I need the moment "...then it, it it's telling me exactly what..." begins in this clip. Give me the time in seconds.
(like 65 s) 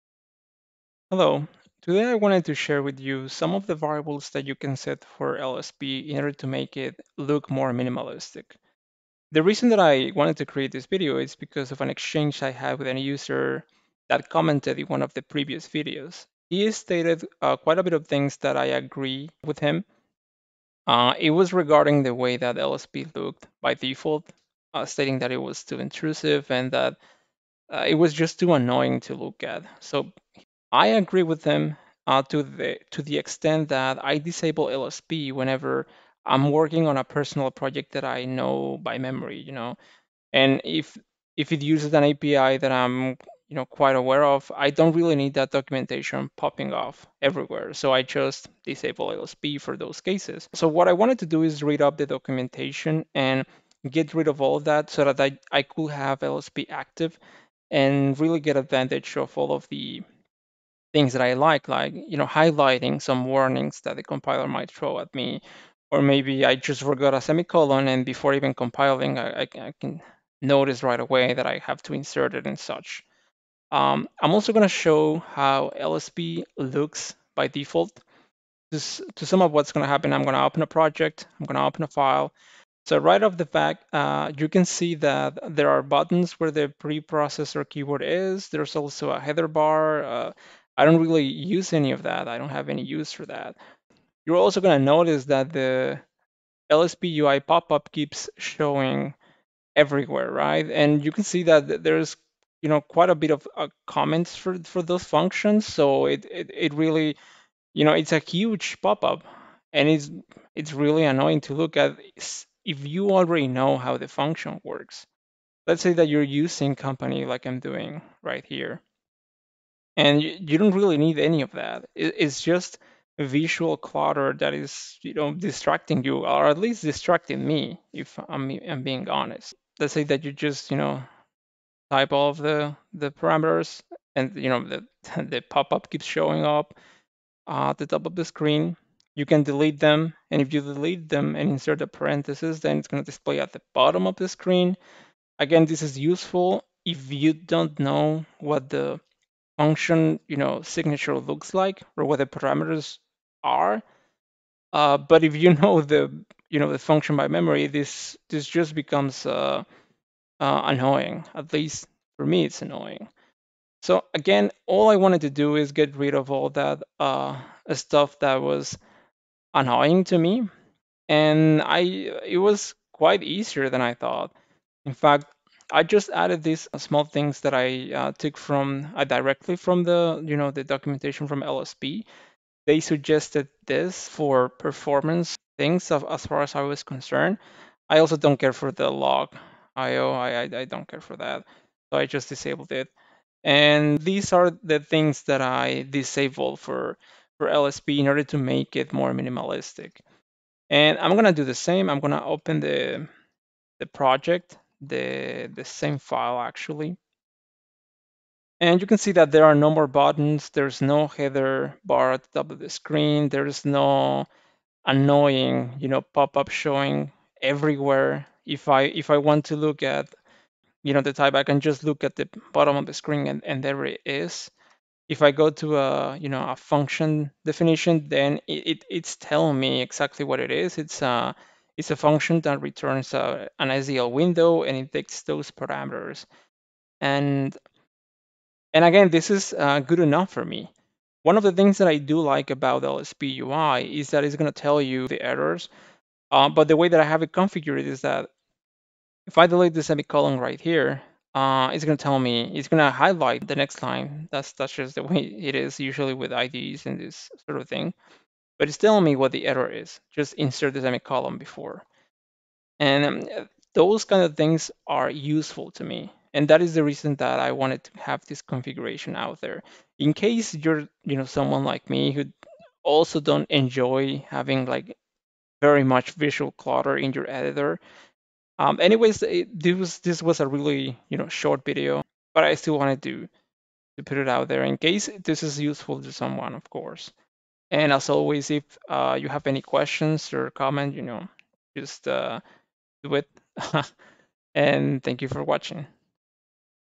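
228 s.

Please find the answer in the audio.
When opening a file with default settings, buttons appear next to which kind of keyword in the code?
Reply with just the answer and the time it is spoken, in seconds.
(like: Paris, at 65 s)
preprocessor keyword, at 86 s.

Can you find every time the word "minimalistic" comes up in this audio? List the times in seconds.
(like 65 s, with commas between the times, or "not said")
7 s, 199 s.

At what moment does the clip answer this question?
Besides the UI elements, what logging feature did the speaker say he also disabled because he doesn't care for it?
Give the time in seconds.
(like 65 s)
188 s.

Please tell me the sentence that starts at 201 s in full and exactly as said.
I'm gonna open the, the project the, the same file actually.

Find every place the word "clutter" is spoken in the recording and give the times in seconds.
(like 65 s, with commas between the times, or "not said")
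123 s, 276 s.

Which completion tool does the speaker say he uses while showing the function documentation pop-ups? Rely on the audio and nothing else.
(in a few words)
company.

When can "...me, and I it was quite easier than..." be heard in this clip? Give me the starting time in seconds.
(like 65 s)
170 s.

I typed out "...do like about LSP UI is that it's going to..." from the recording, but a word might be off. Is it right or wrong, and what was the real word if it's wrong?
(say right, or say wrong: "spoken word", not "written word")
right.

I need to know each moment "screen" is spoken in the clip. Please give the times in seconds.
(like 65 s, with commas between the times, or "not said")
138 s, 144 s, 212 s, 222 s.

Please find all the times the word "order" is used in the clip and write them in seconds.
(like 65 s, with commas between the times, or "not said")
6 s, 198 s.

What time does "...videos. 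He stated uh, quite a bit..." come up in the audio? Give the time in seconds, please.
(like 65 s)
15 s.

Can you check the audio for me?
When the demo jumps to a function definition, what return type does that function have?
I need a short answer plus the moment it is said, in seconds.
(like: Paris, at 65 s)
SDL window, at 233 s.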